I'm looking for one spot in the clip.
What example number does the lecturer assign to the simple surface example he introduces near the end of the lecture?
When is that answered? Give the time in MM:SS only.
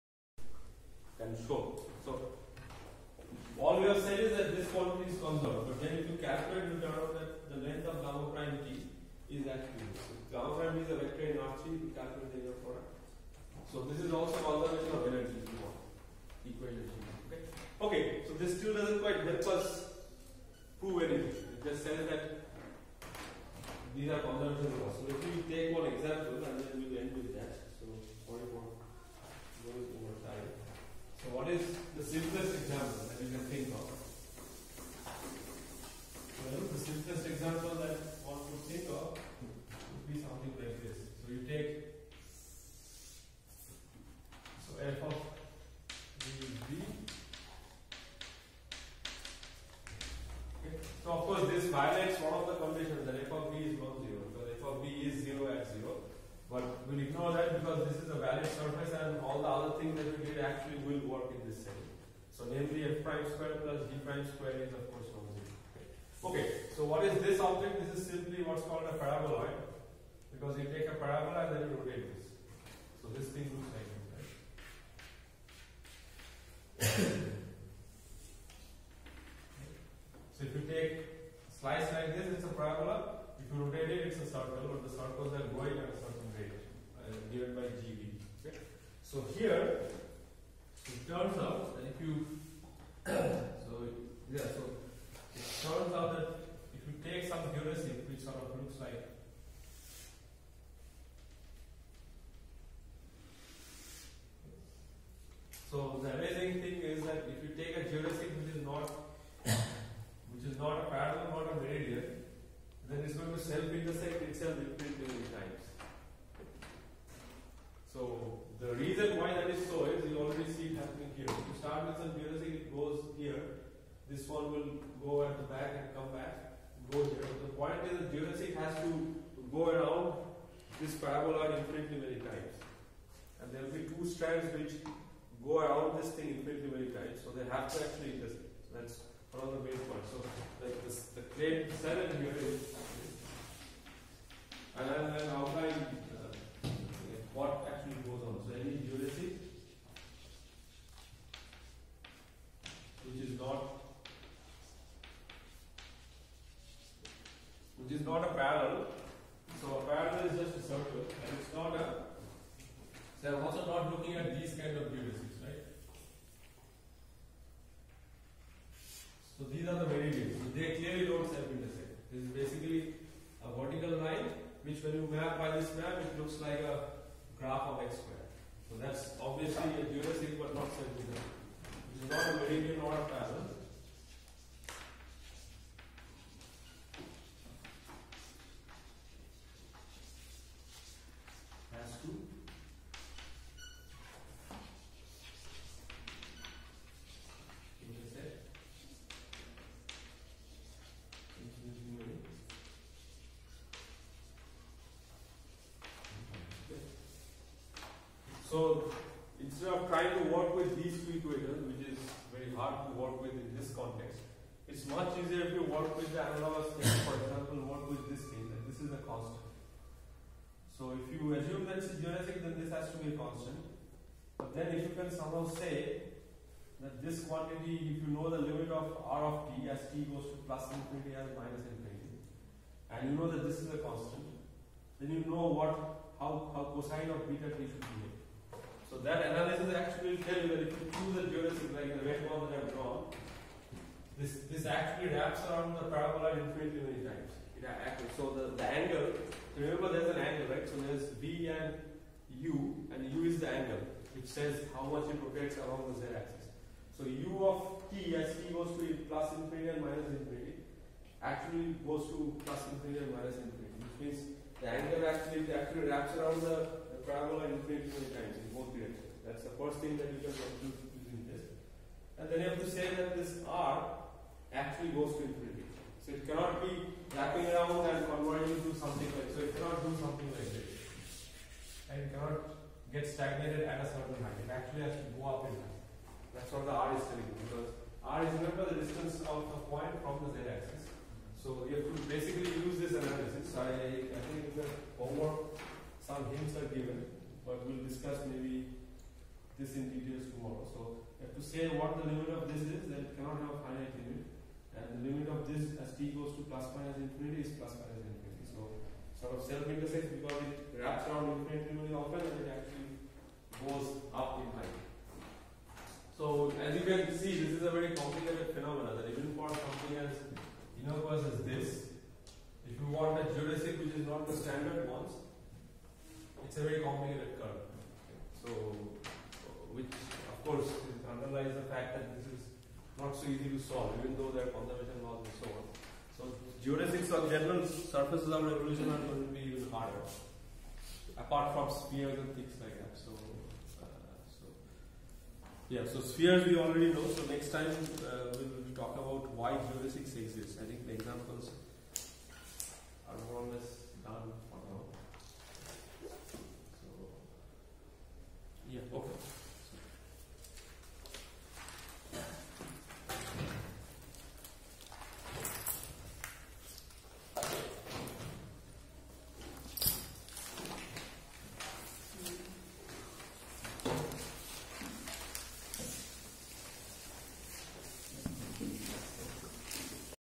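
00:28.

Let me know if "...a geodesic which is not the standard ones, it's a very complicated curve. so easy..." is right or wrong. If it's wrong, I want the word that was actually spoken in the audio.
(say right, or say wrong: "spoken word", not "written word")
right.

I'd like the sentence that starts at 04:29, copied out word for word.
That's the first thing that you can conclude using this.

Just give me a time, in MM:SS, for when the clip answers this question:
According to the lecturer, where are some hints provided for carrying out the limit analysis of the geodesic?
04:54.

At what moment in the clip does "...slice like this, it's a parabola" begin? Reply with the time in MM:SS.
01:21.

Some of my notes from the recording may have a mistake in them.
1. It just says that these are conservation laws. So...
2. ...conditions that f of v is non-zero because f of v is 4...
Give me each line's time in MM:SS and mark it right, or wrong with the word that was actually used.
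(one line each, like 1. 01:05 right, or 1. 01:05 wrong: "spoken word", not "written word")
1. 00:21 right
2. 00:52 wrong: "0", not "4".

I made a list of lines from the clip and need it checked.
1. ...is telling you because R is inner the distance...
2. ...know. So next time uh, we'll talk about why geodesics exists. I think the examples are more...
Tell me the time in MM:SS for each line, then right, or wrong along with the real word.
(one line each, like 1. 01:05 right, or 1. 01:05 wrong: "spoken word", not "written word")
1. 04:46 wrong: "remember", not "inner"
2. 05:46 right.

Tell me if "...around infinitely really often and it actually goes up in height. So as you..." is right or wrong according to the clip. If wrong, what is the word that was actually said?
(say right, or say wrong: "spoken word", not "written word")
right.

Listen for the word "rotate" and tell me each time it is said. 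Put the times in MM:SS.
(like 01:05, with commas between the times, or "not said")
01:11, 01:23, 04:15.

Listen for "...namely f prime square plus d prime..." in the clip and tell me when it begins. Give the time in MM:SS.
01:02.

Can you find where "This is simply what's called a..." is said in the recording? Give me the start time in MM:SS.
01:07.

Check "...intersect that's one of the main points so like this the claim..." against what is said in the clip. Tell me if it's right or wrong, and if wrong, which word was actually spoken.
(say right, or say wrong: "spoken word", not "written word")
right.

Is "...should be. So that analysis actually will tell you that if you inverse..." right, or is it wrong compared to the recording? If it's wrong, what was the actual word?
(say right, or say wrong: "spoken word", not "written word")
wrong: "choose", not "inverse".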